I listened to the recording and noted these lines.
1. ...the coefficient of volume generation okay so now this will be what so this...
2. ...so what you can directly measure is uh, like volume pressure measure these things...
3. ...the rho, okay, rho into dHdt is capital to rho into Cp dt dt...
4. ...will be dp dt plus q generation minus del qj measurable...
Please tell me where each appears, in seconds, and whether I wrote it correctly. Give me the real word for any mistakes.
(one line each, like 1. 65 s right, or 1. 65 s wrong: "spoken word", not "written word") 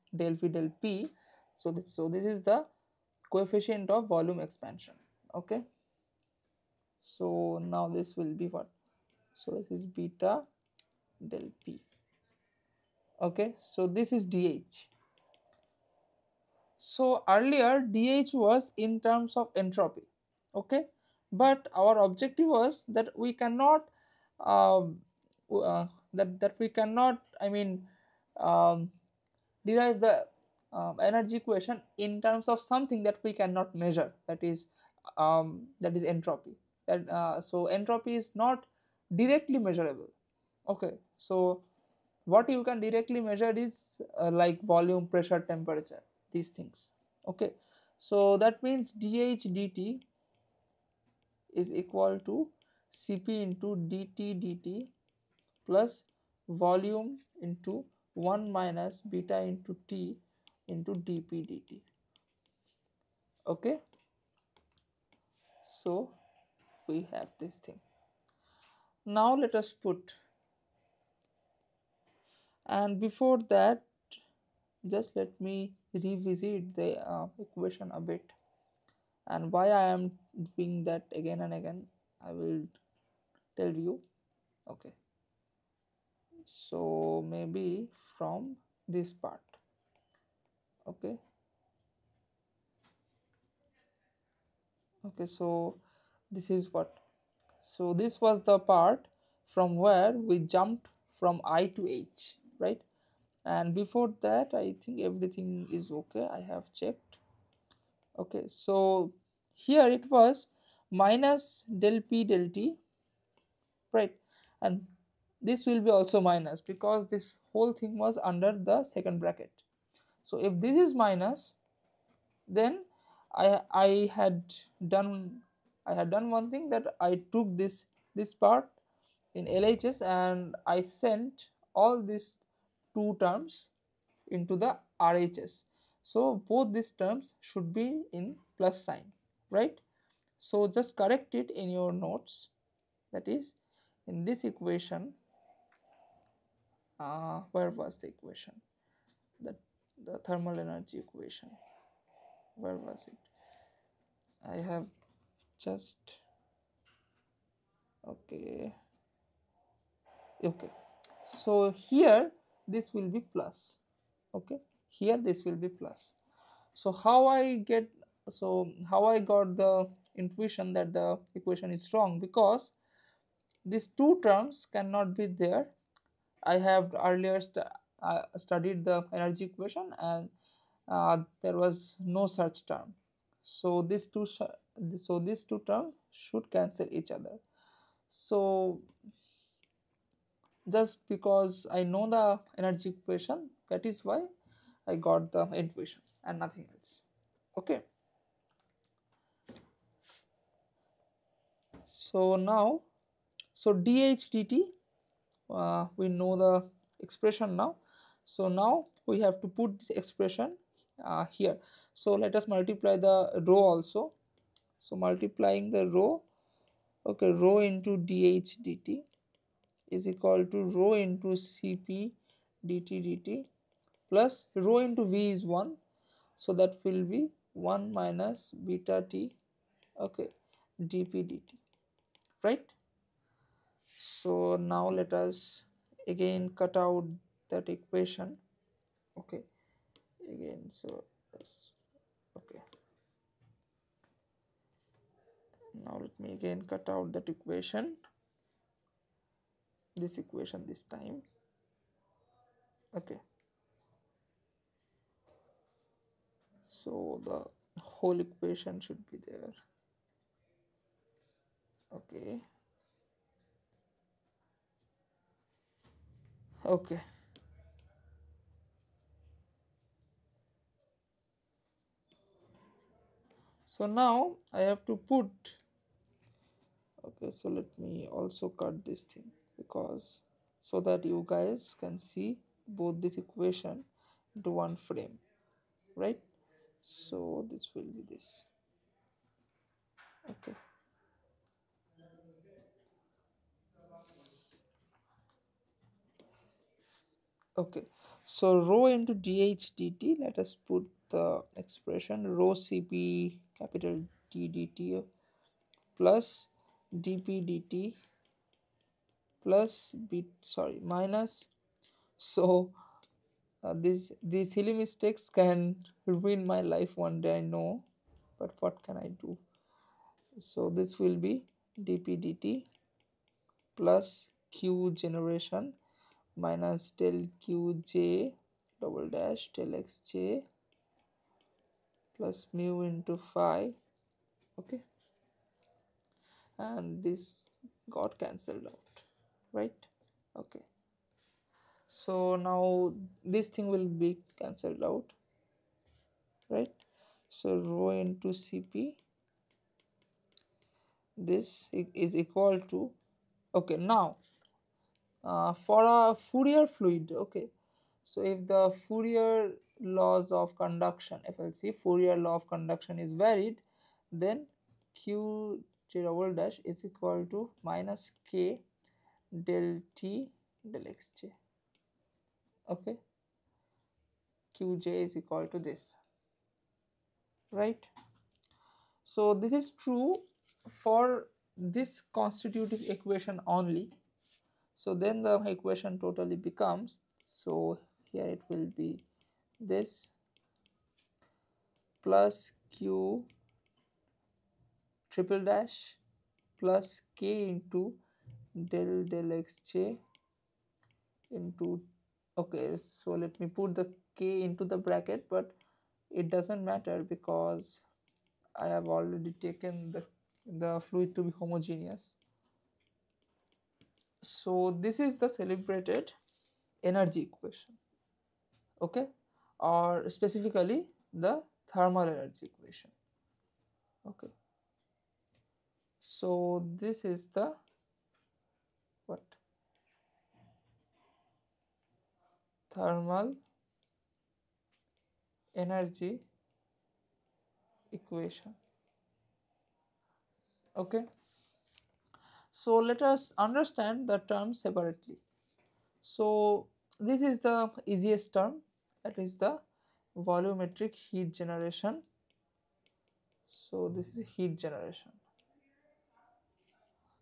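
1. 2 s wrong: "expansion", not "generation"
2. 41 s wrong: "temperature", not "measure"
3. 215 s wrong: "equal", not "capital"
4. 321 s wrong: "double", not "measurable".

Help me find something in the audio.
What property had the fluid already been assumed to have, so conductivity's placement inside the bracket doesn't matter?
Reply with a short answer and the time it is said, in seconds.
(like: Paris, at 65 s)
Homogeneous, at 411 s.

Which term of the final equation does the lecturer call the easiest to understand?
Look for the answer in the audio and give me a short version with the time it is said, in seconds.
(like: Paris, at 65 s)
Volumetric heat generation, at 450 s.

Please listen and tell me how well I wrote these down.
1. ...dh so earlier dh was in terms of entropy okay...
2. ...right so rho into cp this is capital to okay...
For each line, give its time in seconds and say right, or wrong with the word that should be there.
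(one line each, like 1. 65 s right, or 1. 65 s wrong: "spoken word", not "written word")
1. 14 s right
2. 346 s wrong: "equal", not "capital".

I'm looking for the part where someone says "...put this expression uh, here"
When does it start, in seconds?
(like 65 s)
209 s.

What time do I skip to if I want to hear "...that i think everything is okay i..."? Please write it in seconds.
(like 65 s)
104 s.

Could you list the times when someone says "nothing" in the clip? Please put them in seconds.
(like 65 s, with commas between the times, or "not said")
196 s.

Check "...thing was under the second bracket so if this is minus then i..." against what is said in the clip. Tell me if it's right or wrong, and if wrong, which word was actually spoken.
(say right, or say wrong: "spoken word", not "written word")
right.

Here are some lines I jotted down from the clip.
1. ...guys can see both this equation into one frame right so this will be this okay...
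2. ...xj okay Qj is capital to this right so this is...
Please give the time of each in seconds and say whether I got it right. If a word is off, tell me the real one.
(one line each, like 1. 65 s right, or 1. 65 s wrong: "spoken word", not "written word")
1. 281 s right
2. 370 s wrong: "equal", not "capital".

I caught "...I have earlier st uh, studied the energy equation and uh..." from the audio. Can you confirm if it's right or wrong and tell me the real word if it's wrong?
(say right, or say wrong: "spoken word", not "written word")
right.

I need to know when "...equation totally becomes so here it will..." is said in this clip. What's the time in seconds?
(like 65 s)
385 s.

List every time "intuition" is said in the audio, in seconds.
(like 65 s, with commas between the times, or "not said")
170 s, 195 s.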